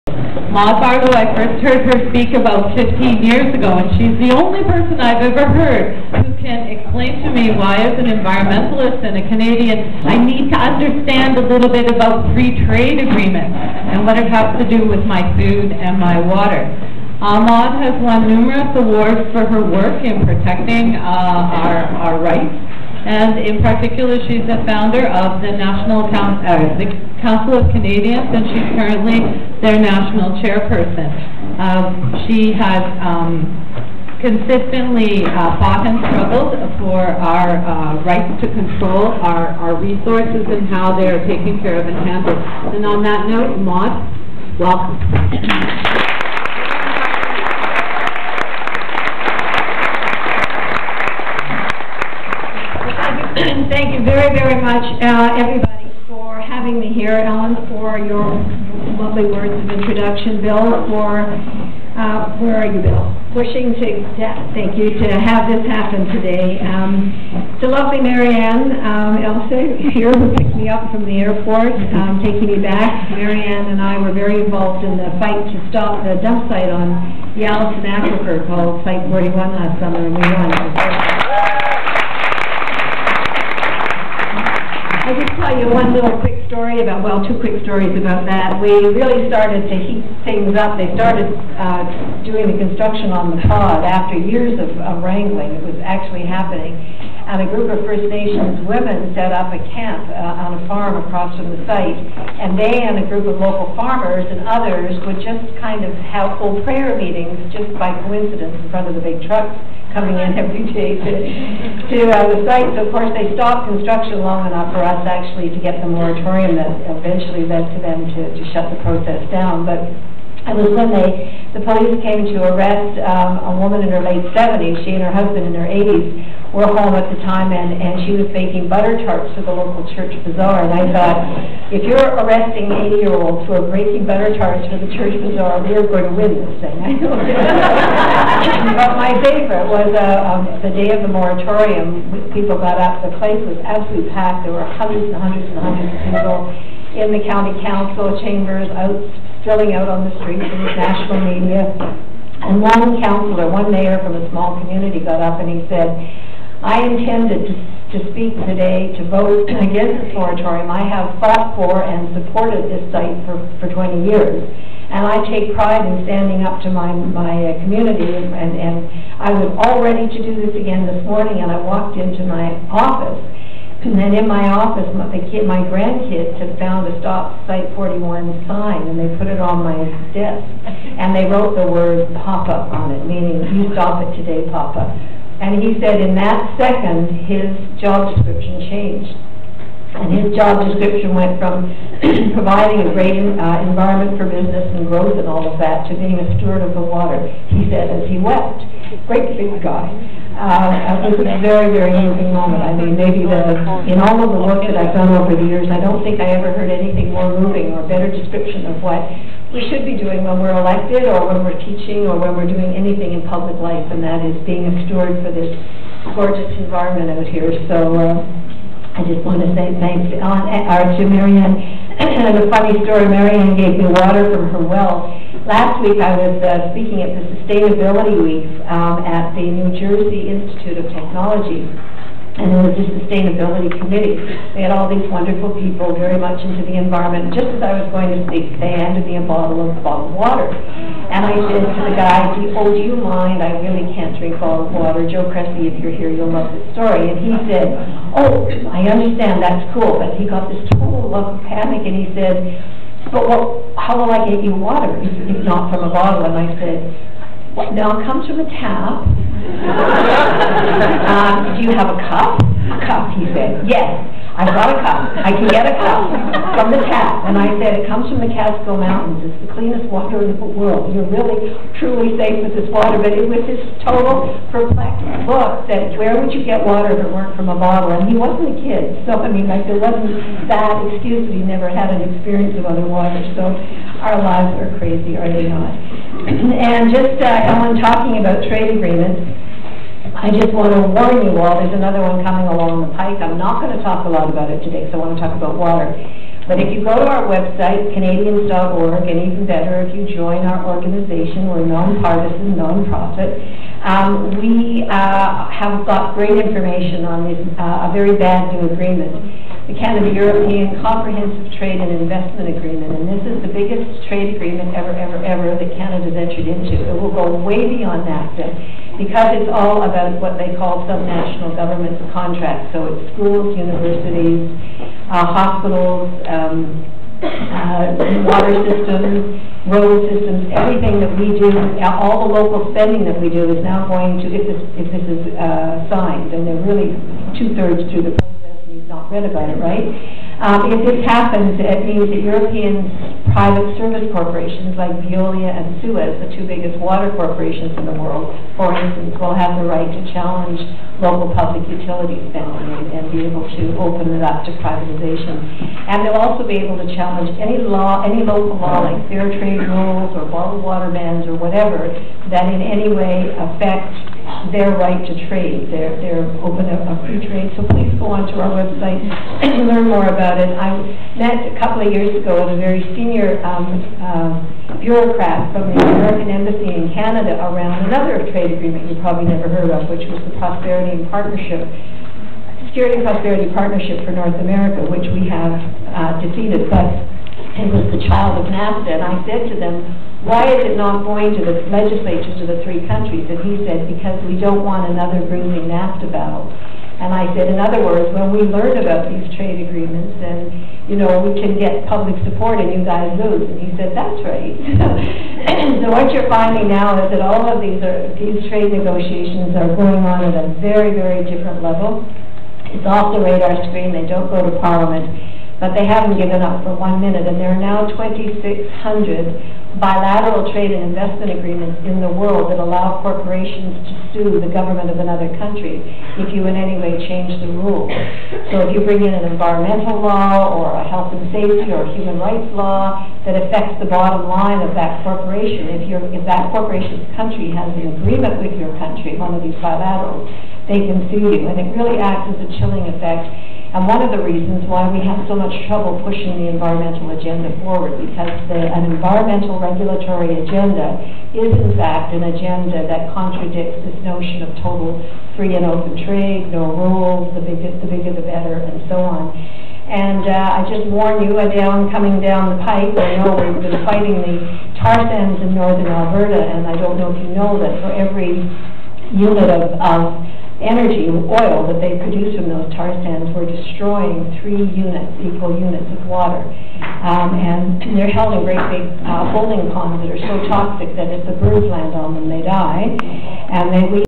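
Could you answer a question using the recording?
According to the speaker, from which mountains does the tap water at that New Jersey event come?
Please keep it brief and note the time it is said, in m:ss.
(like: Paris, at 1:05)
Catskill Mountains, at 4:28.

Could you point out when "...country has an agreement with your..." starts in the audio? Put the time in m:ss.
7:17.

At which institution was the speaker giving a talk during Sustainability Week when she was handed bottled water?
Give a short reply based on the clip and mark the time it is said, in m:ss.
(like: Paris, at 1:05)
New Jersey Institute of Technology, at 3:49.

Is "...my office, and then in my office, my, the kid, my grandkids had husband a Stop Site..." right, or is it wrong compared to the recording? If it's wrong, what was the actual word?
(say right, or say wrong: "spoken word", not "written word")
wrong: "found", not "husband".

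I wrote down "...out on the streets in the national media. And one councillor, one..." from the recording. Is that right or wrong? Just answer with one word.
right.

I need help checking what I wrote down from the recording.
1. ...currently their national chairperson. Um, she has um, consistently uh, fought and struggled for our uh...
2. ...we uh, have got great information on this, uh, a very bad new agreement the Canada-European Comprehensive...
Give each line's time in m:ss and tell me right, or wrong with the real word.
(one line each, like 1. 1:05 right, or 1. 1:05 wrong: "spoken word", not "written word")
1. 0:28 right
2. 5:04 right.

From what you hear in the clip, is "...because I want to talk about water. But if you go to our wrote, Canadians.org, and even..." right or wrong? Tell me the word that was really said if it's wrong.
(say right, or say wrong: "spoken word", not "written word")
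wrong: "website", not "wrote".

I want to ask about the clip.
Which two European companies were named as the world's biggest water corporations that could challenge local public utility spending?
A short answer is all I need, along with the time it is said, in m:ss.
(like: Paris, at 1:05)
Veolia and Suez, at 5:45.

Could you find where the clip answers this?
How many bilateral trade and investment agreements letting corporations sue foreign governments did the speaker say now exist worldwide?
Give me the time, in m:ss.
6:57.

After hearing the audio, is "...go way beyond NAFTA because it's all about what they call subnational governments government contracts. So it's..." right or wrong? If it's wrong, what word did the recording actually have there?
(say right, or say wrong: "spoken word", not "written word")
right.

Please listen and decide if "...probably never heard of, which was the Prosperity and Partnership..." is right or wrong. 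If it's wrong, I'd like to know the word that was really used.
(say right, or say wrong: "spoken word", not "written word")
right.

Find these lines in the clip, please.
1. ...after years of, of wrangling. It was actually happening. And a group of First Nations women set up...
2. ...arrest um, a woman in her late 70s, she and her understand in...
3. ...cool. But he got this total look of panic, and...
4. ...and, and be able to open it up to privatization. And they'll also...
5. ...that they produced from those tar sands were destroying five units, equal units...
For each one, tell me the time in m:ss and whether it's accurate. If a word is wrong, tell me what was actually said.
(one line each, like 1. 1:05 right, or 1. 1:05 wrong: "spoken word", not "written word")
1. 1:33 right
2. 2:02 wrong: "husband", not "understand"
3. 4:09 right
4. 5:52 right
5. 7:51 wrong: "three", not "five".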